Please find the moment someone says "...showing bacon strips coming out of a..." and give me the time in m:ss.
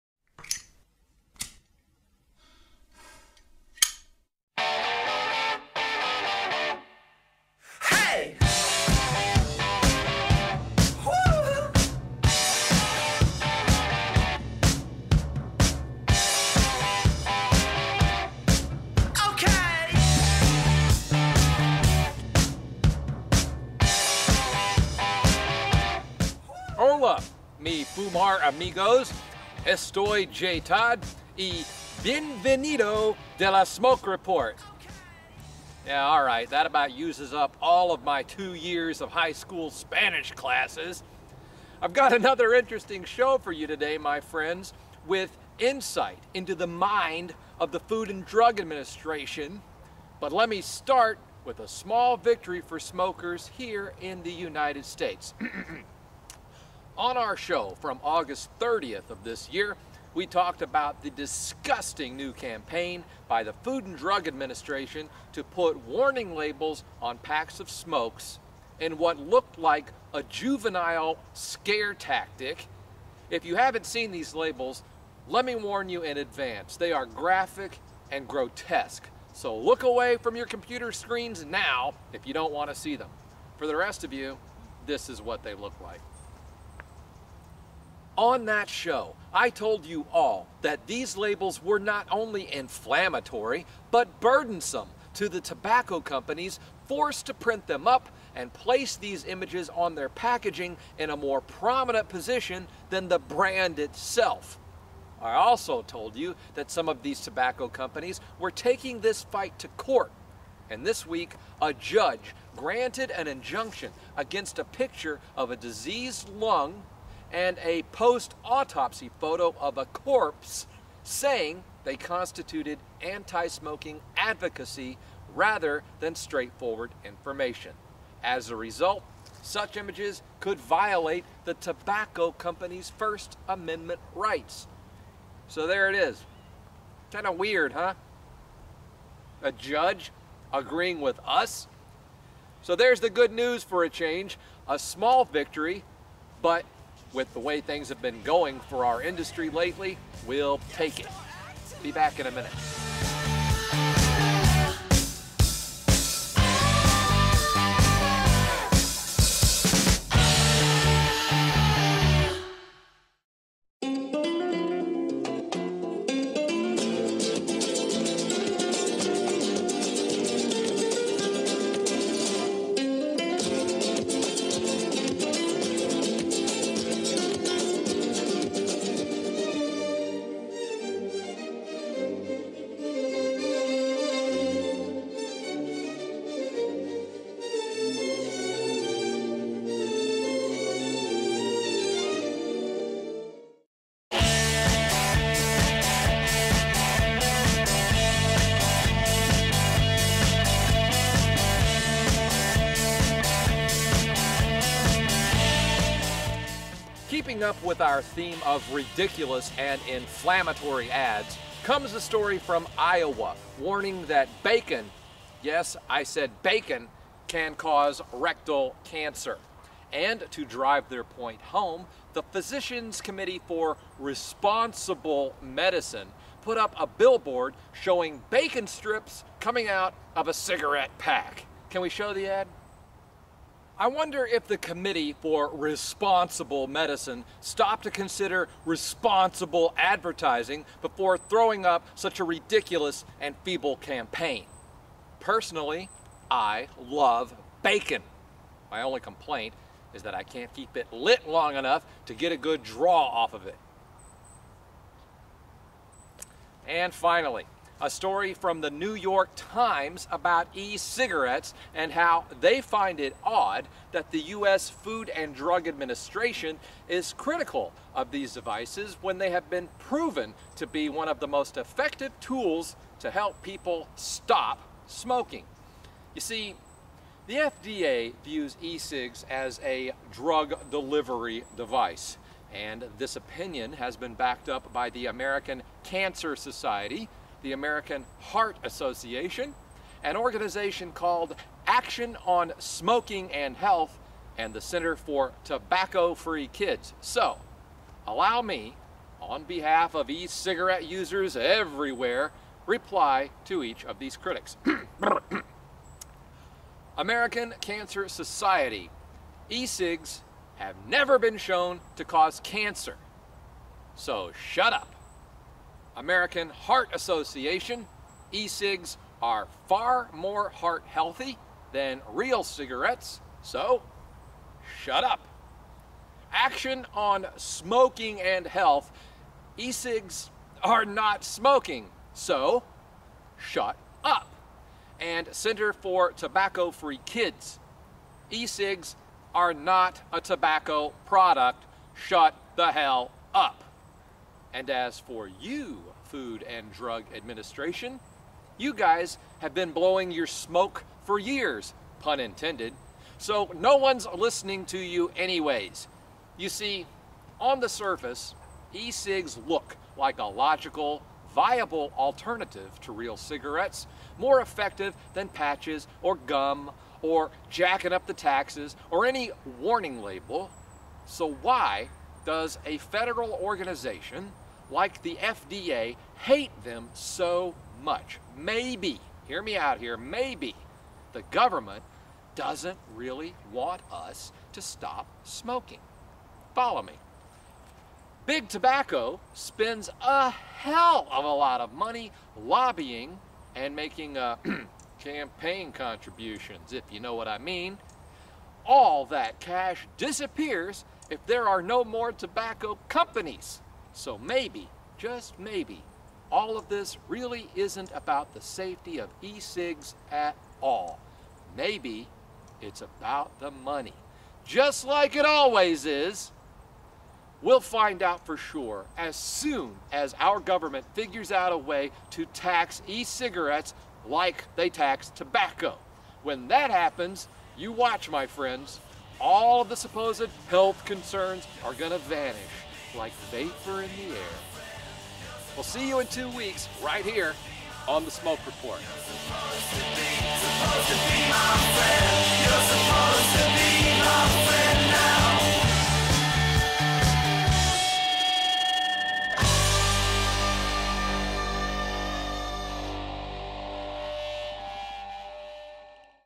3:47.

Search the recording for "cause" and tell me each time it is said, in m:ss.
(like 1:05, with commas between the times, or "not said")
3:37, 5:12.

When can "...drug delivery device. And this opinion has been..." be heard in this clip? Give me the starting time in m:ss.
4:40.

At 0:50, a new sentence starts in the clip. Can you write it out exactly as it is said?
But let me start with a small victory for smokers here in the United States.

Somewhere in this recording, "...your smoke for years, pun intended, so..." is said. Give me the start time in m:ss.
5:50.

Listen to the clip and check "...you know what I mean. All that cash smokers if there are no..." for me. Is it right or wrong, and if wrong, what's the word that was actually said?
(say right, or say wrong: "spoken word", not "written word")
wrong: "disappears", not "smokers".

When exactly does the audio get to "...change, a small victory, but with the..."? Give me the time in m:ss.
2:23.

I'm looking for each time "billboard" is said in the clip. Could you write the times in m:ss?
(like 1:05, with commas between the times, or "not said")
3:46.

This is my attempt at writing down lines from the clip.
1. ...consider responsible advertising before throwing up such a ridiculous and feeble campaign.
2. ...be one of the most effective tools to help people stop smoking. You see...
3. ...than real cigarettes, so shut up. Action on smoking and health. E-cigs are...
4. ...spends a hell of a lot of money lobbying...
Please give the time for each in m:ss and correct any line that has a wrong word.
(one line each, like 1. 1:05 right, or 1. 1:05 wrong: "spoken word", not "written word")
1. 3:57 right
2. 4:30 right
3. 5:21 right
4. 6:29 right.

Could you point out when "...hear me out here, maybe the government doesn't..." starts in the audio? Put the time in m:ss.
6:19.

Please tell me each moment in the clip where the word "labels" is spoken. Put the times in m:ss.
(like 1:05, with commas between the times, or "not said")
1:06, 1:14, 1:31, 6:10.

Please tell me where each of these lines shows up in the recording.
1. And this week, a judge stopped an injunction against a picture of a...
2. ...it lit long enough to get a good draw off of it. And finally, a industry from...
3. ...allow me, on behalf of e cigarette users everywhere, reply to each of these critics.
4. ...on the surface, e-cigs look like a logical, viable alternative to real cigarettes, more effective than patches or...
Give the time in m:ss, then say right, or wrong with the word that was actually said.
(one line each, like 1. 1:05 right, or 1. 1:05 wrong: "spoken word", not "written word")
1. 1:50 wrong: "granted", not "stopped"
2. 4:10 wrong: "story", not "industry"
3. 4:58 right
4. 5:57 right.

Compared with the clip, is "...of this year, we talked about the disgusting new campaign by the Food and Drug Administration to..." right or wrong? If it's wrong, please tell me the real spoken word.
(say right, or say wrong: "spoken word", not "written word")
right.